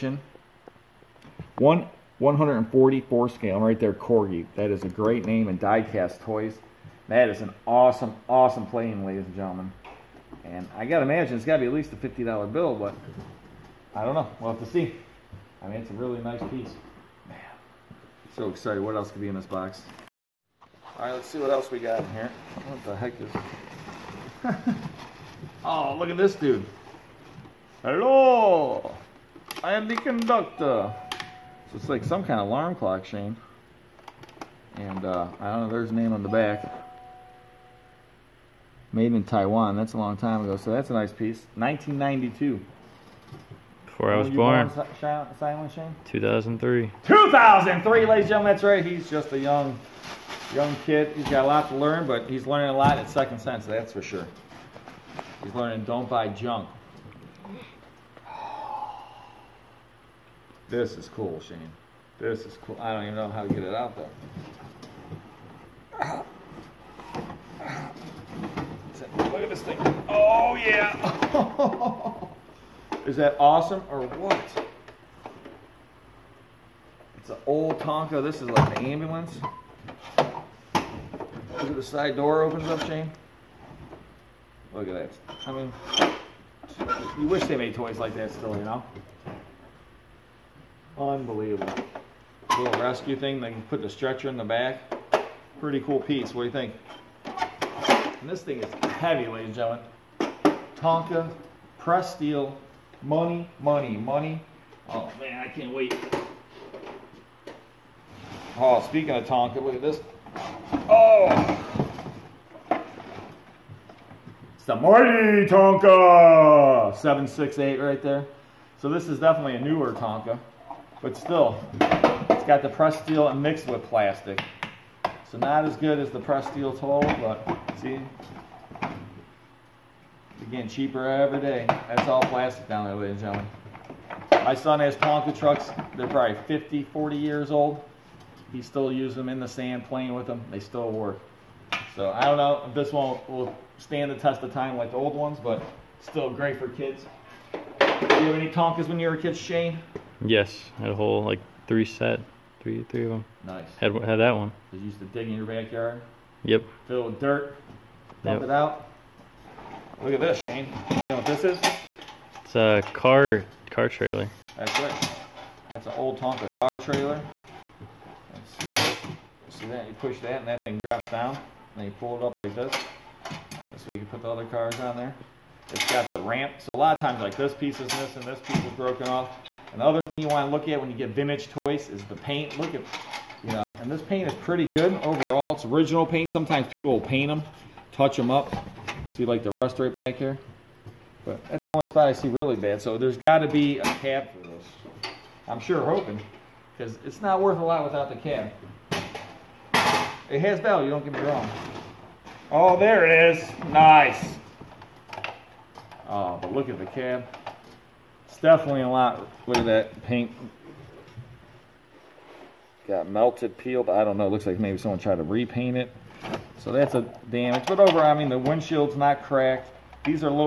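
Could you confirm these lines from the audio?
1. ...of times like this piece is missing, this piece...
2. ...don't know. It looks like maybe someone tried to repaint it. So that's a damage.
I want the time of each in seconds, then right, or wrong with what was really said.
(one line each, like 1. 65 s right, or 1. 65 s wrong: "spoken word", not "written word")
1. 176 s right
2. 214 s right.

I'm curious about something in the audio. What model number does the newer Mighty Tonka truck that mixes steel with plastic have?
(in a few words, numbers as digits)
768.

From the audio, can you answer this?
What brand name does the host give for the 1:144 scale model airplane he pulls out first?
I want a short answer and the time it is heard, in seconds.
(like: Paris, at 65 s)
Corgi, at 3 s.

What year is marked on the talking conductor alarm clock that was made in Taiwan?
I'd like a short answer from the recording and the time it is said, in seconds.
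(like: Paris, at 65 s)
1992, at 41 s.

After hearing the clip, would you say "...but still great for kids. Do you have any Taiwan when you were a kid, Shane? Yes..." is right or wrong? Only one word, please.
wrong.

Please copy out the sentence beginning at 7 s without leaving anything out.
That is an awesome, awesome plane, ladies and gentlemen.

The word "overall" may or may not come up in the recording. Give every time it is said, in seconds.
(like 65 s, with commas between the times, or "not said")
185 s, 217 s.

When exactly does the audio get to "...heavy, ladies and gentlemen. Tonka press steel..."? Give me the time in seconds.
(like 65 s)
98 s.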